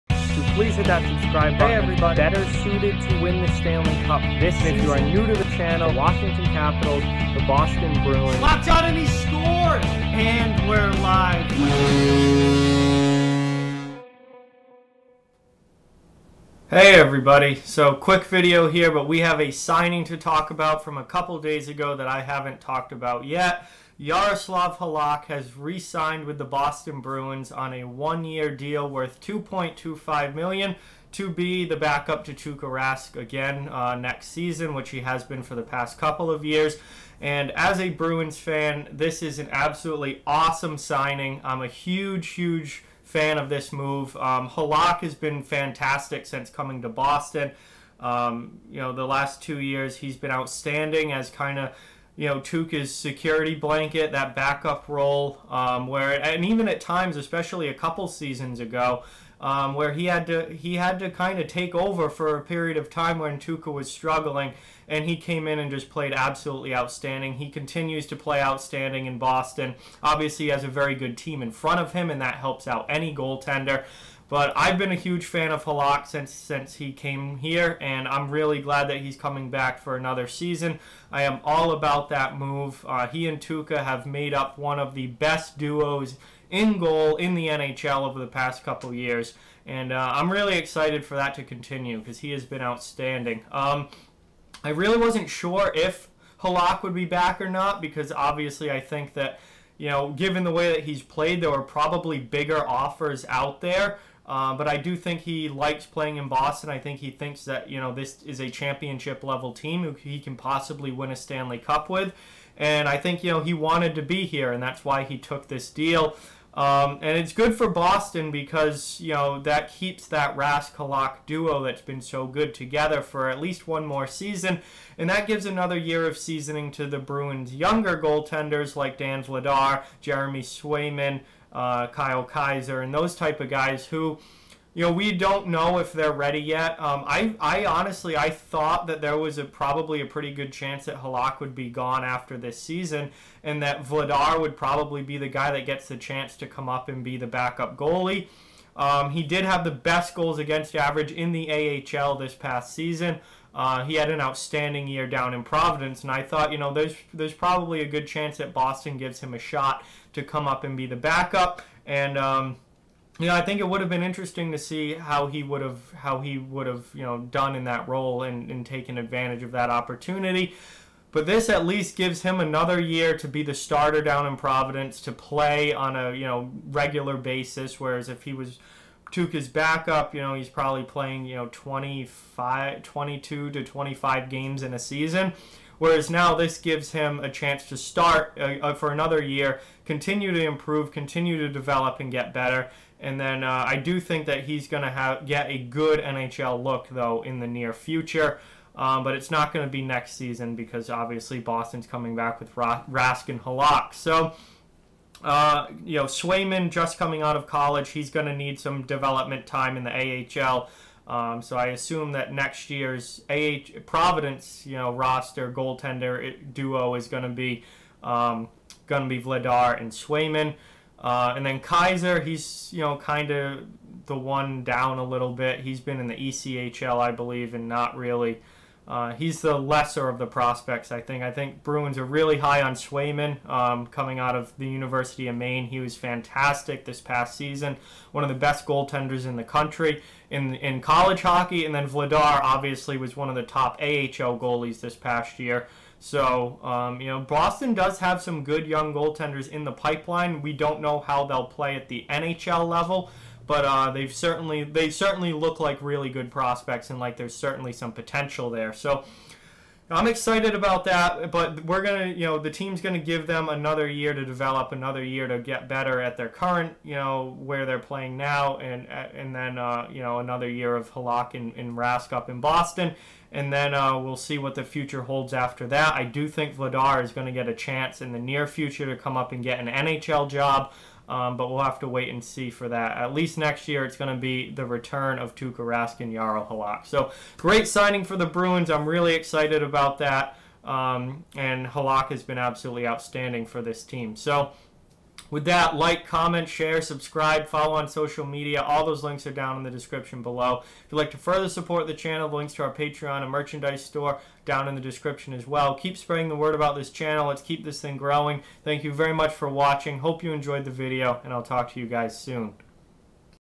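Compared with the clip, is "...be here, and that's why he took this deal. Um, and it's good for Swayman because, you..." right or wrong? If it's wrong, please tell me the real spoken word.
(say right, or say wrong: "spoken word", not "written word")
wrong: "Boston", not "Swayman".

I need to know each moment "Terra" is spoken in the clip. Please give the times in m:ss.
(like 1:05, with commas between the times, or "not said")
not said.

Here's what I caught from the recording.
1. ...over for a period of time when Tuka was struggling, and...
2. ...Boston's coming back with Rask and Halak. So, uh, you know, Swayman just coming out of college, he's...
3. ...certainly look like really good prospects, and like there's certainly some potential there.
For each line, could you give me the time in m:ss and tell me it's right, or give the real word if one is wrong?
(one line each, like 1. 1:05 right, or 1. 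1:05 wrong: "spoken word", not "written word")
1. 1:01 right
2. 3:21 right
3. 4:14 right.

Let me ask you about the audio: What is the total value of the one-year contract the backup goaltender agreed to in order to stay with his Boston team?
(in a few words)
$2.25 million.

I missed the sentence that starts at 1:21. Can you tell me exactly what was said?
I am all about that move.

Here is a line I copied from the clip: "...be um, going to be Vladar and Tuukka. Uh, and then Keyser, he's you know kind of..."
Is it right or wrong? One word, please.
wrong.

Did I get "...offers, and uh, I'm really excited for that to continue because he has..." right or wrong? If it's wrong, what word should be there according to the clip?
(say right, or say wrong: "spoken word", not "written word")
wrong: "years", not "offers".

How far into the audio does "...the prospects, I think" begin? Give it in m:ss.
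3:50.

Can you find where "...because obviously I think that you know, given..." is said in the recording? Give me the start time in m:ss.
1:37.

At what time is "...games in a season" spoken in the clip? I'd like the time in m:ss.
3:04.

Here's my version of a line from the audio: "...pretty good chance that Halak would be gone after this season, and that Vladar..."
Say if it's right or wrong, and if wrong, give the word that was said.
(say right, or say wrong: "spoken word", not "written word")
right.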